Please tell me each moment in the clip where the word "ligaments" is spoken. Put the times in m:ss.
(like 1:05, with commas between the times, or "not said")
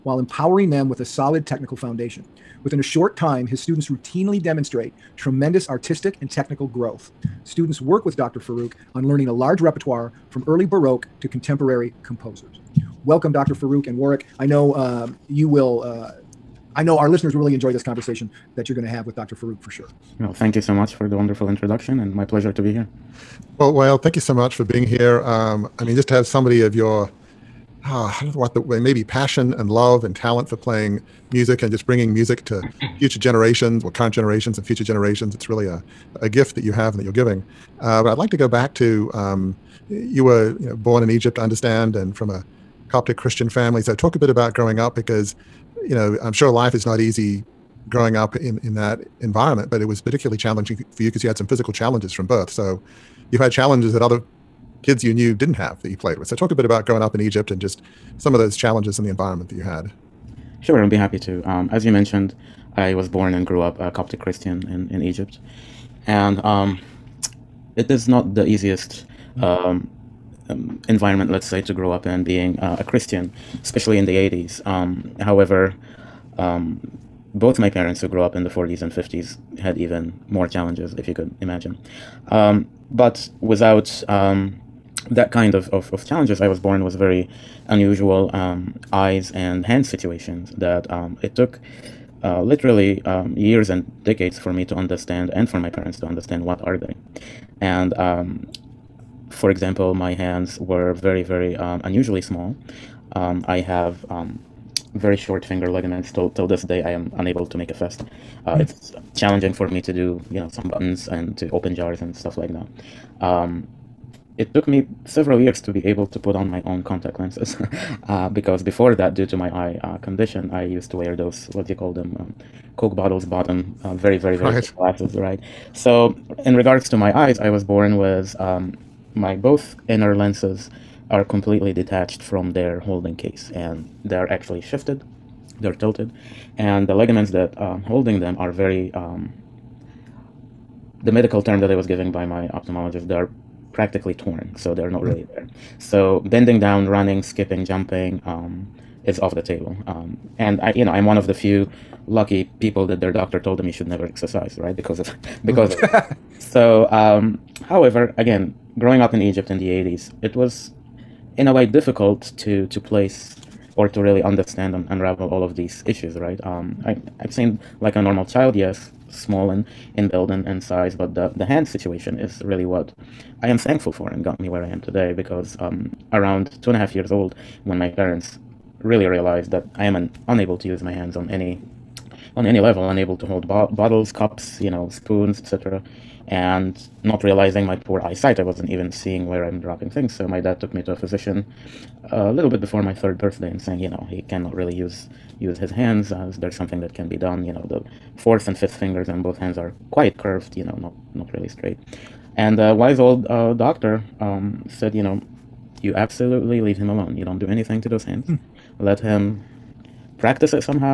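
1:45, 2:16.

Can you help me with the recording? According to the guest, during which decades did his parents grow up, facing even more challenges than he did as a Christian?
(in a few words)
40s and 50s.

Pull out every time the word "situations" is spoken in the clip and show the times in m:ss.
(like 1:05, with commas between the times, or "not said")
1:29, 2:51.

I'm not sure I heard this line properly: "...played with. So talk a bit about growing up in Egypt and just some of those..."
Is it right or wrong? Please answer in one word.
right.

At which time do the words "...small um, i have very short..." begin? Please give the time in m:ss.
1:42.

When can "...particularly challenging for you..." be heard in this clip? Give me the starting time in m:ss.
0:50.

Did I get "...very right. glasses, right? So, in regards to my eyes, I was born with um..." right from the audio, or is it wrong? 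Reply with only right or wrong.
right.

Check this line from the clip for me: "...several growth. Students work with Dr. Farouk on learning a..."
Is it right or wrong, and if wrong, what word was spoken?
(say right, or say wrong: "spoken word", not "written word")
wrong: "technical", not "several".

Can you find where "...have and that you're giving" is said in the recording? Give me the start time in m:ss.
0:36.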